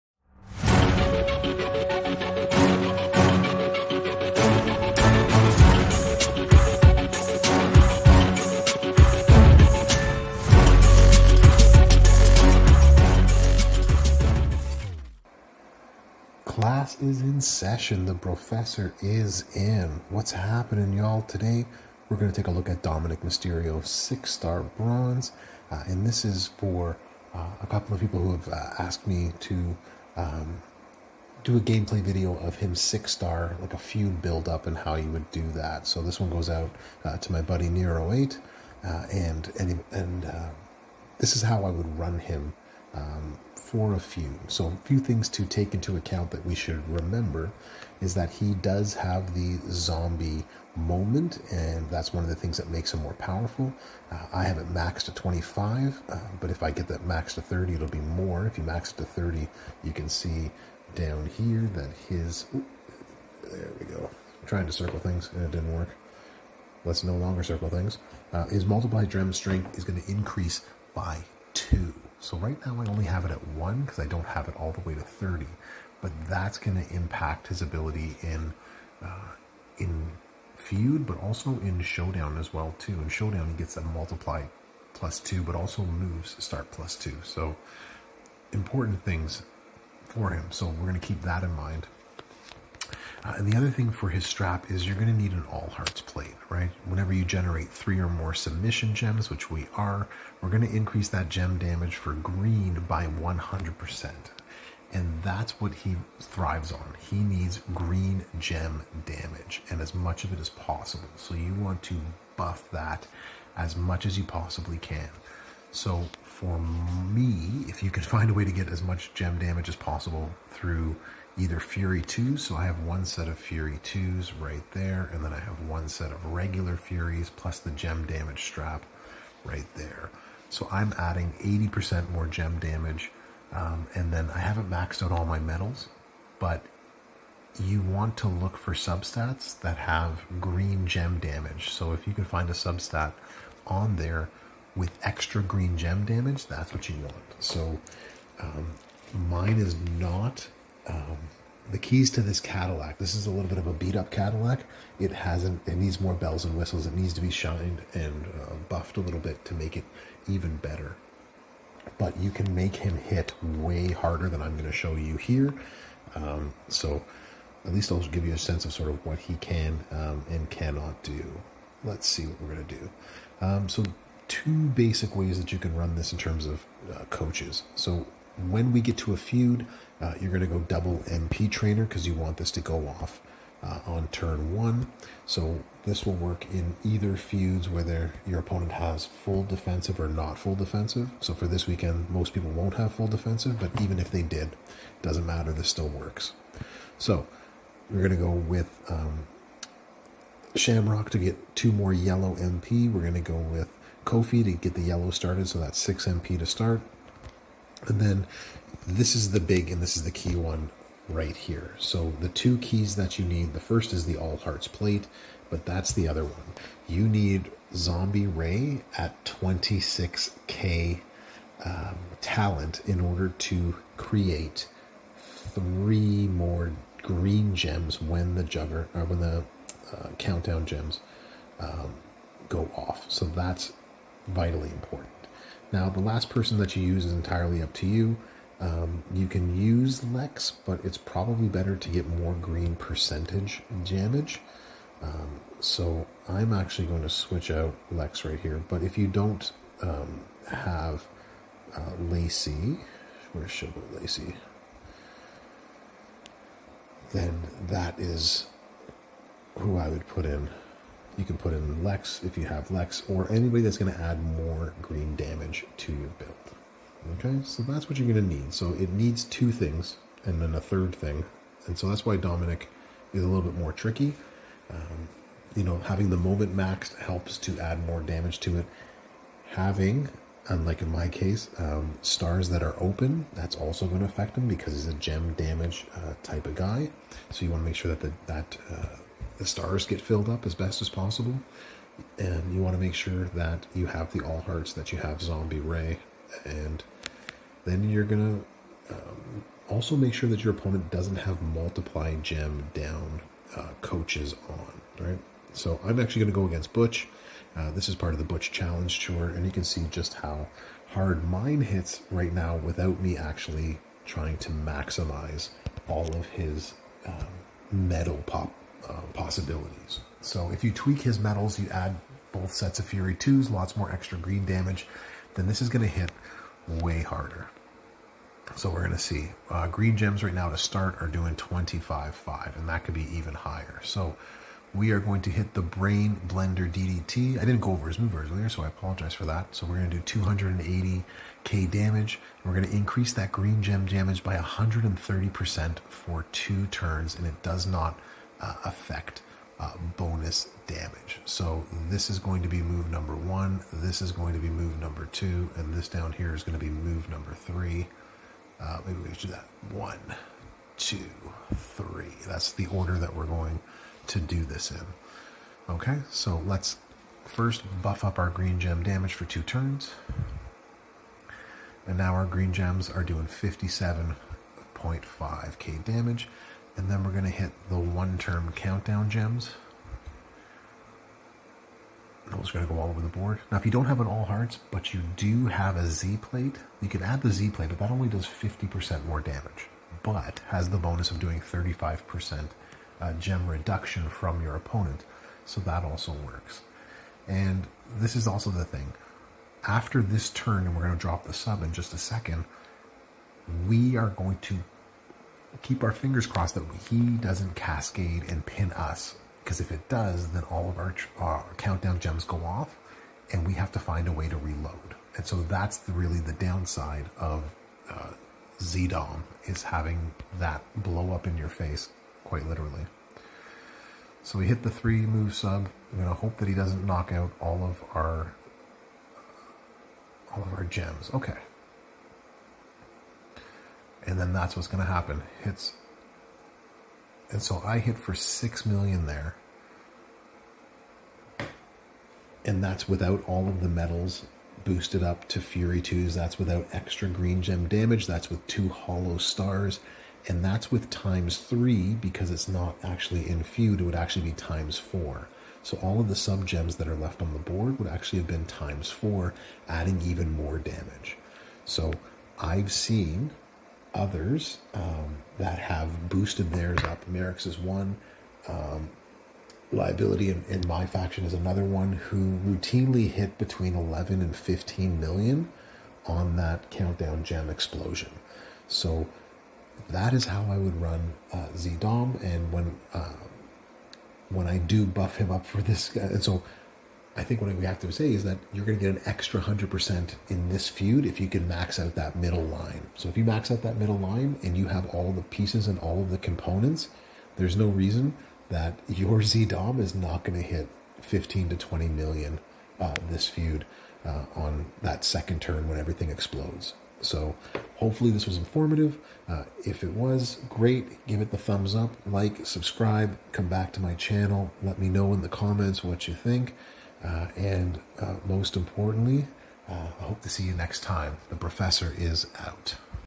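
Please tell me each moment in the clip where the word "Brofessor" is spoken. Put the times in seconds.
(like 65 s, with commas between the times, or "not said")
18 s, 521 s.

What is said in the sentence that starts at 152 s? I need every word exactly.
This is a little bit of a beat up Cadillac.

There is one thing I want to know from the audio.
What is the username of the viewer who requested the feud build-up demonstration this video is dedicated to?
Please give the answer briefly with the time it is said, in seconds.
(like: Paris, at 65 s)
Nero8, at 37 s.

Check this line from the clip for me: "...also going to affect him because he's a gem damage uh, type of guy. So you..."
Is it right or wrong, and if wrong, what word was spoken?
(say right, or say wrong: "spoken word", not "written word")
right.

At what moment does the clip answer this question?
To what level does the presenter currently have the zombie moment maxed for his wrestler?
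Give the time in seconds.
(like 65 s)
55 s.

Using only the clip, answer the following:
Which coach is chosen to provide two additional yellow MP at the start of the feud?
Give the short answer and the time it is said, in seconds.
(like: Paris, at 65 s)
Shamrock, at 200 s.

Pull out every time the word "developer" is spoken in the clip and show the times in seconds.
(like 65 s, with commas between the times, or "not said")
not said.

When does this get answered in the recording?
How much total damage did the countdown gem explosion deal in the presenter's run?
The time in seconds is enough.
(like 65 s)
438 s.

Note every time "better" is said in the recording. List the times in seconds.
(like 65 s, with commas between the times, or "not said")
160 s, 241 s.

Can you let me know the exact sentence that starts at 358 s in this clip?
Uh, maybe we should do that.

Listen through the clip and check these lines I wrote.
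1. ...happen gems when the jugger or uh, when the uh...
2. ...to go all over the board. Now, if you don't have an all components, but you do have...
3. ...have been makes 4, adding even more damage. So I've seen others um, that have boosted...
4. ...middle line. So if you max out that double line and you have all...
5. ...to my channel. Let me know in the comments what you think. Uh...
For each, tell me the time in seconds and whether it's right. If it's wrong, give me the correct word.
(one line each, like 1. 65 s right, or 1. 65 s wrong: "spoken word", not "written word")
1. 227 s wrong: "green", not "happen"
2. 382 s wrong: "hearts", not "components"
3. 458 s wrong: "times", not "makes"
4. 492 s wrong: "middle", not "double"
5. 513 s right.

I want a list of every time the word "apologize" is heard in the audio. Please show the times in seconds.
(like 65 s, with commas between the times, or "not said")
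338 s.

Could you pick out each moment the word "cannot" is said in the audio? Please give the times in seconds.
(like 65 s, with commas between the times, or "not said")
170 s.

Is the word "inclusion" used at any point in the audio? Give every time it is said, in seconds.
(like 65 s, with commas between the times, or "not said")
not said.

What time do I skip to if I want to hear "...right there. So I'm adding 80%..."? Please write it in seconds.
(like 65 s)
129 s.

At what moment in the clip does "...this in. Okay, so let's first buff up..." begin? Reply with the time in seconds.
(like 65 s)
364 s.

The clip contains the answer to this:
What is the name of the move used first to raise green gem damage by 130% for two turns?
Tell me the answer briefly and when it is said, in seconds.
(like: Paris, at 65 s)
Brain Blender DDT, at 335 s.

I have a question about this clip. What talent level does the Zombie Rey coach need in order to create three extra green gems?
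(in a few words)
26k.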